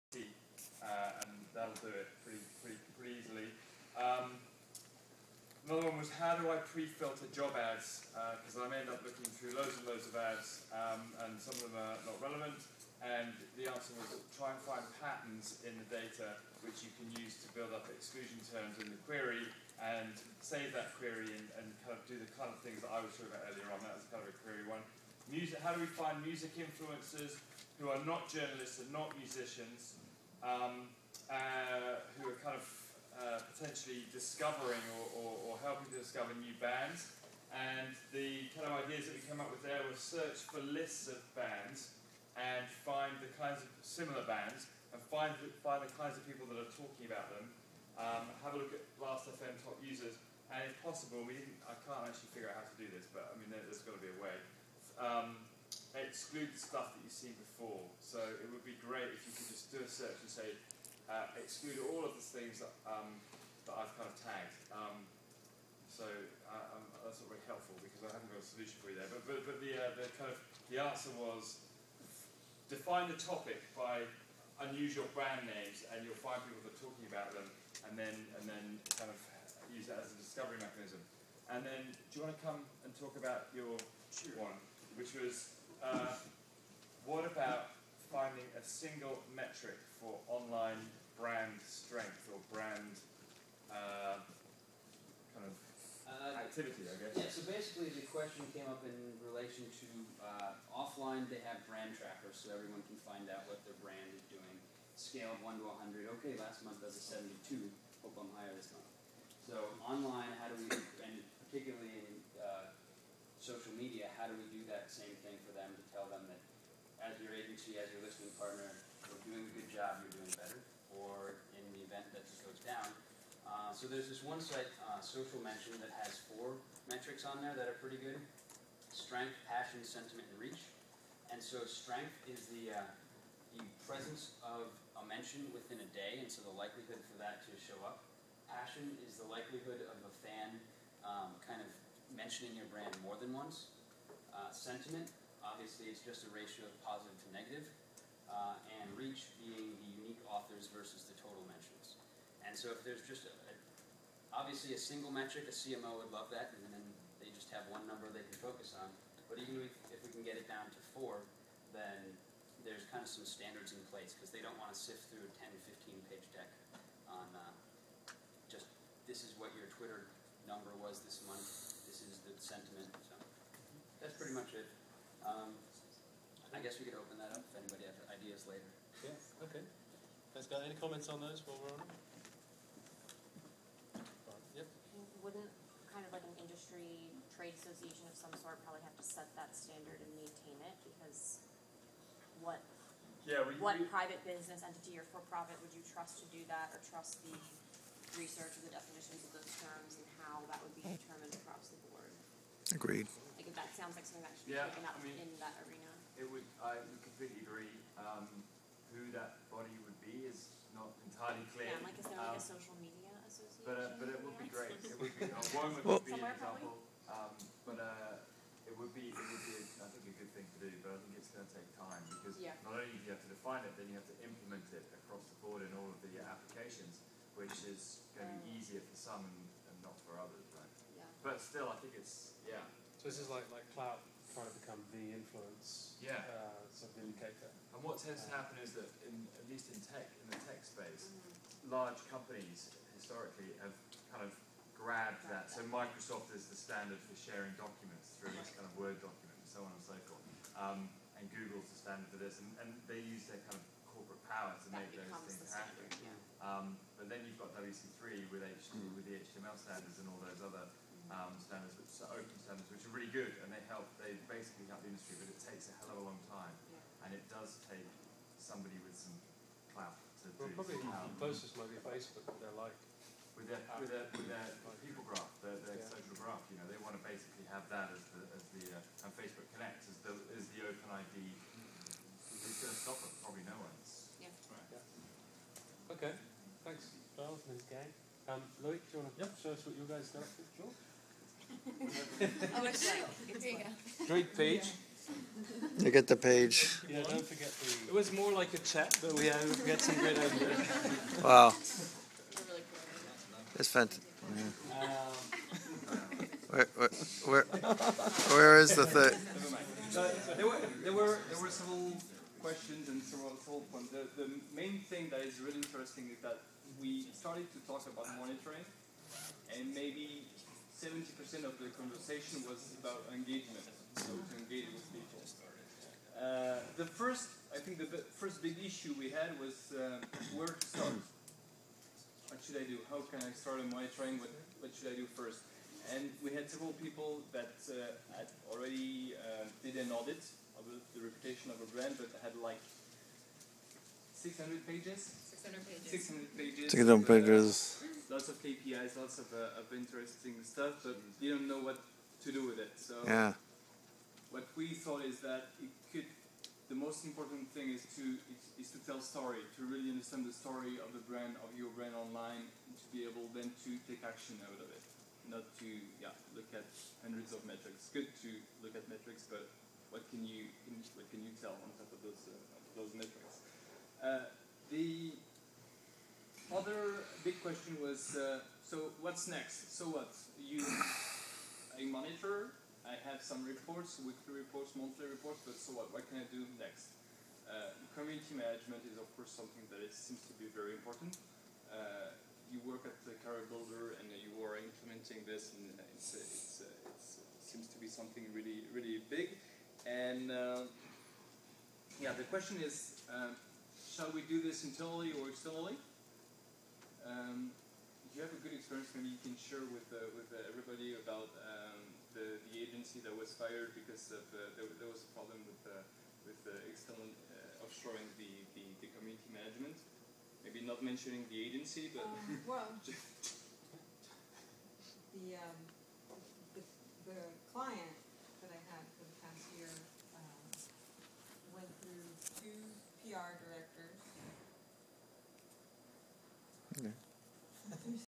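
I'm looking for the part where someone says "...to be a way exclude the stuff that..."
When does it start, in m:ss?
0:53.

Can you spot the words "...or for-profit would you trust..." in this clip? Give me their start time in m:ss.
3:14.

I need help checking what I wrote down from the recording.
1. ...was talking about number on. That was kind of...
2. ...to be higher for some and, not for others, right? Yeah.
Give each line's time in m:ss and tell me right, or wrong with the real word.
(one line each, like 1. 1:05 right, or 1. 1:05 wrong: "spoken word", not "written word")
1. 0:23 wrong: "earlier", not "number"
2. 3:48 wrong: "easier", not "higher".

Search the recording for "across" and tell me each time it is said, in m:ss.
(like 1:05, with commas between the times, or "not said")
3:21, 3:45.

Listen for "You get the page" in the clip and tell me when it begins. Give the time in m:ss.
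4:55.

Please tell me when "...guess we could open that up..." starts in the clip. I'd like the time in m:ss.
2:56.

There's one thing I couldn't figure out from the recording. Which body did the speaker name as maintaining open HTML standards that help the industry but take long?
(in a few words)
WC3.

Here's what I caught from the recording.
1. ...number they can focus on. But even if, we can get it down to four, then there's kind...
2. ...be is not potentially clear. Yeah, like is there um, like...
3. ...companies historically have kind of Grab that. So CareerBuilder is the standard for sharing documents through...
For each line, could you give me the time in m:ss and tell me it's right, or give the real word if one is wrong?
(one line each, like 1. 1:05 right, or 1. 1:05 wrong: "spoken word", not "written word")
1. 2:37 right
2. 3:30 wrong: "entirely", not "potentially"
3. 4:02 wrong: "Microsoft", not "CareerBuilder".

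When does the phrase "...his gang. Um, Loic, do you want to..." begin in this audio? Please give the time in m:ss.
4:47.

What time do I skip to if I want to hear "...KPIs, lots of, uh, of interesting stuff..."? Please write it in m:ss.
5:48.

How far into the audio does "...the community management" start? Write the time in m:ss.
6:58.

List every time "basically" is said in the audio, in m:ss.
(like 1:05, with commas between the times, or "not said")
1:37, 4:24, 4:37.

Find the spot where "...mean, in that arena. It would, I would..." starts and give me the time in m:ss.
3:25.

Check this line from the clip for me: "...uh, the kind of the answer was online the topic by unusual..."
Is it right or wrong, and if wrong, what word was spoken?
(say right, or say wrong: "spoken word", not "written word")
wrong: "define", not "online".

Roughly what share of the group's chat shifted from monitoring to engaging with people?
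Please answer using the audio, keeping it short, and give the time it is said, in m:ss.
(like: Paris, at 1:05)
70%, at 5:20.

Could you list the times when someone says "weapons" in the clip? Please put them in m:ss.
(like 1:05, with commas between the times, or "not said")
not said.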